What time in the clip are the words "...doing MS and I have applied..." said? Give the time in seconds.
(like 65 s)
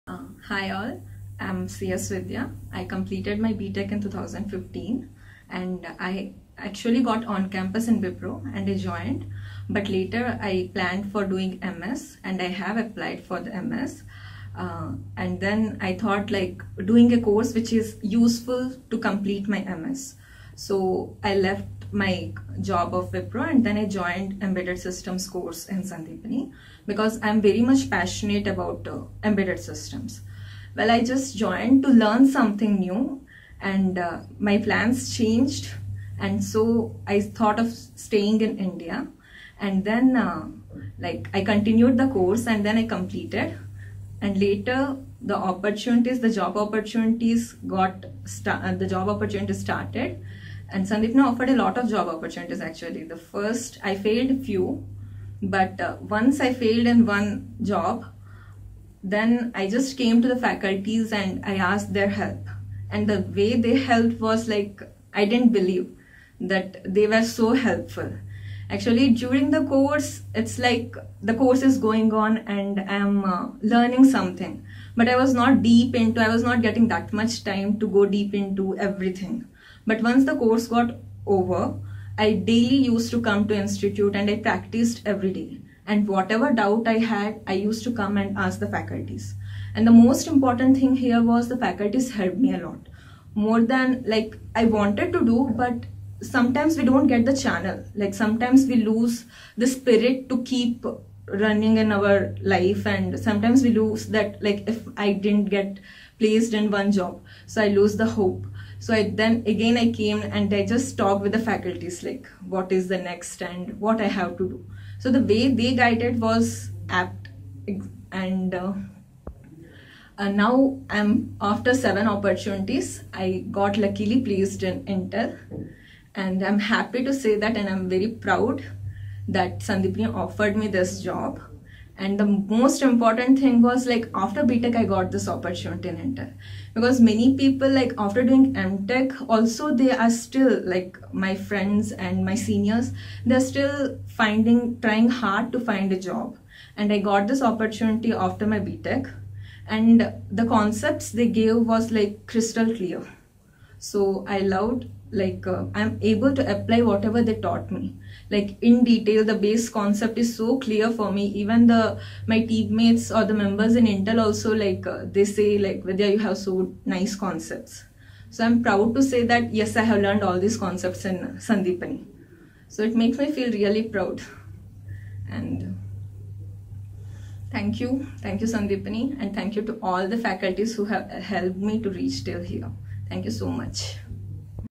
11 s.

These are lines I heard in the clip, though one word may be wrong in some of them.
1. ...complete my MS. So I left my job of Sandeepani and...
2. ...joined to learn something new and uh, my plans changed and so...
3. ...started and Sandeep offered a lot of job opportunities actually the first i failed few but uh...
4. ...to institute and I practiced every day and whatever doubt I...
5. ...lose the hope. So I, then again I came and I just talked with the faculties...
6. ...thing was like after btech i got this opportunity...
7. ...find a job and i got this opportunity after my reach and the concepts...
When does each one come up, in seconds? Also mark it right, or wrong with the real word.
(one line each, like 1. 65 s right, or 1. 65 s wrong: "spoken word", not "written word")
1. 18 s wrong: "Wipro", not "Sandeepani"
2. 31 s right
3. 49 s right
4. 83 s right
5. 107 s right
6. 133 s right
7. 145 s wrong: "btech", not "reach".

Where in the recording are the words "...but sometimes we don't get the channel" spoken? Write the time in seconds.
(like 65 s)
95 s.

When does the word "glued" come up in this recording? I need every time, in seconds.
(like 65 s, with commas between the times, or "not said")
not said.